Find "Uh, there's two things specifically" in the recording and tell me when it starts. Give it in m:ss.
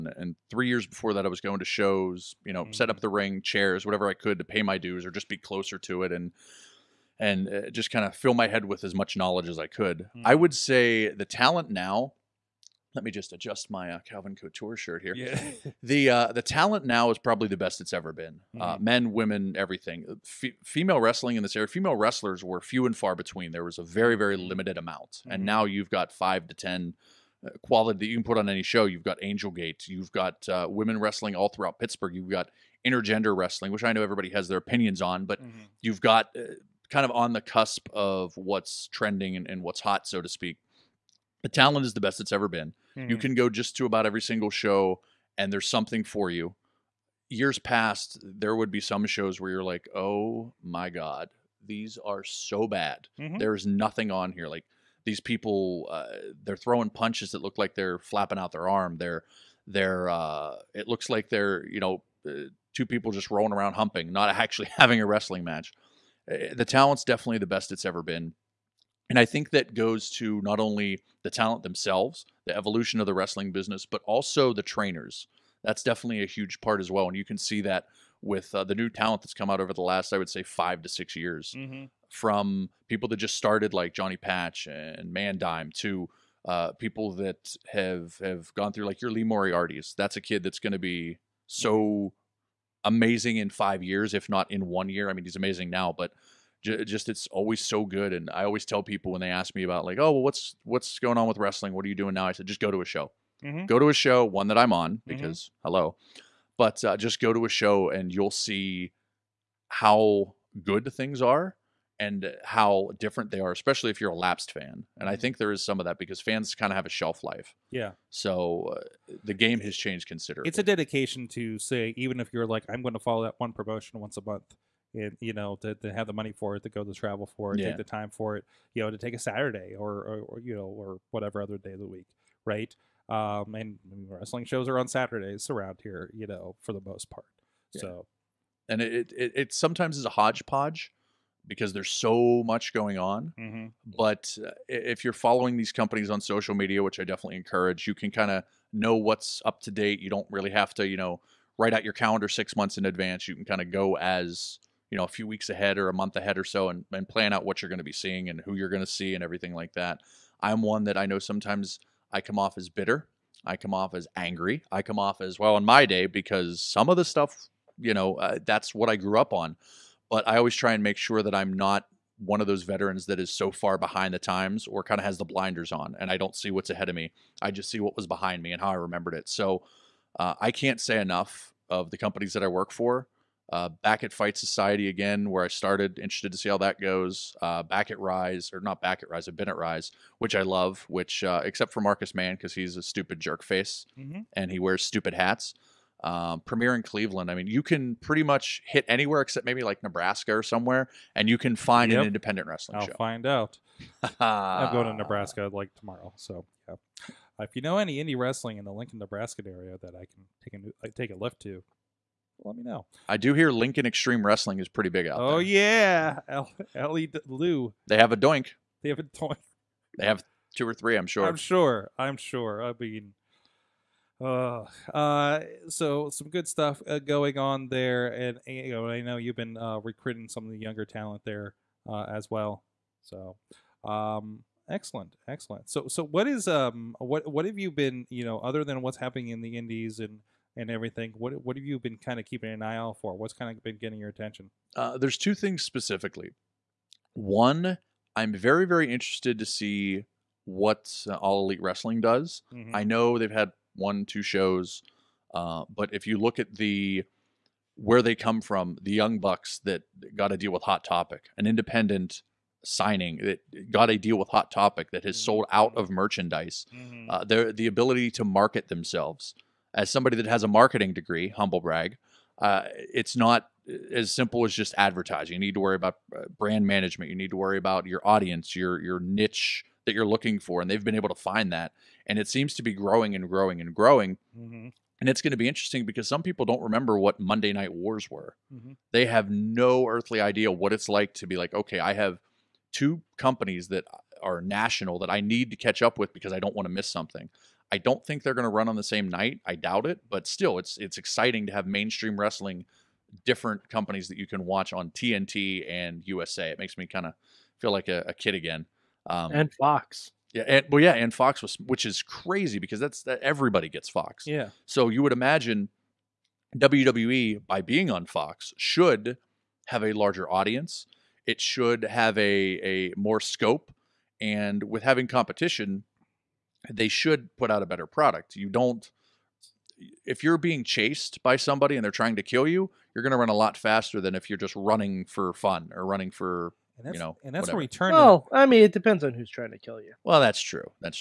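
4:04.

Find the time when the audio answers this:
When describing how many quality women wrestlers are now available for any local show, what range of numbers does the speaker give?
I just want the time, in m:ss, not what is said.
0:26.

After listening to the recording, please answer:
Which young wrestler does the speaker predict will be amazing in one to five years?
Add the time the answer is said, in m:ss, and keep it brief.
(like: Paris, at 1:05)
Lee Moriarty, at 1:29.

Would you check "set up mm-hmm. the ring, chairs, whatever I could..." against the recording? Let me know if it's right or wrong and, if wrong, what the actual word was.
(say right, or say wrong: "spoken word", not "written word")
right.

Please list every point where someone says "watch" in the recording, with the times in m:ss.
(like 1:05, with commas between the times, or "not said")
5:04.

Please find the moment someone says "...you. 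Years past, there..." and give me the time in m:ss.
0:46.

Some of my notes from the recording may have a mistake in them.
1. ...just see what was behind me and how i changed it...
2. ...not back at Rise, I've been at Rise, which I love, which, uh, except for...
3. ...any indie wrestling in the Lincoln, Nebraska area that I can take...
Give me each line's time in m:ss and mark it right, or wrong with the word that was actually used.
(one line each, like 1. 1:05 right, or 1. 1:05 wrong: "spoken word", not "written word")
1. 2:57 wrong: "remembered", not "changed"
2. 3:08 right
3. 3:27 right.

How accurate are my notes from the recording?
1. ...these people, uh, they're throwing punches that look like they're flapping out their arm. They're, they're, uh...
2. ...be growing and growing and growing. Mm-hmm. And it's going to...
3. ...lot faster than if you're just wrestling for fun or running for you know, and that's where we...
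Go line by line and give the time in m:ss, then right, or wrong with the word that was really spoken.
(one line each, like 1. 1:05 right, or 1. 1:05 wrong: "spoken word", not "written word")
1. 0:55 right
2. 4:42 right
3. 5:33 wrong: "running", not "wrestling".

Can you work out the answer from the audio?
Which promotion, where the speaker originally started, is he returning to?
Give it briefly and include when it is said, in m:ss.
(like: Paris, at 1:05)
Fight Society, at 3:04.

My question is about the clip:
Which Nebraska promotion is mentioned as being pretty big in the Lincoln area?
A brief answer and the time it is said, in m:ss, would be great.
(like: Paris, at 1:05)
Lincoln Extreme Wrestling, at 3:33.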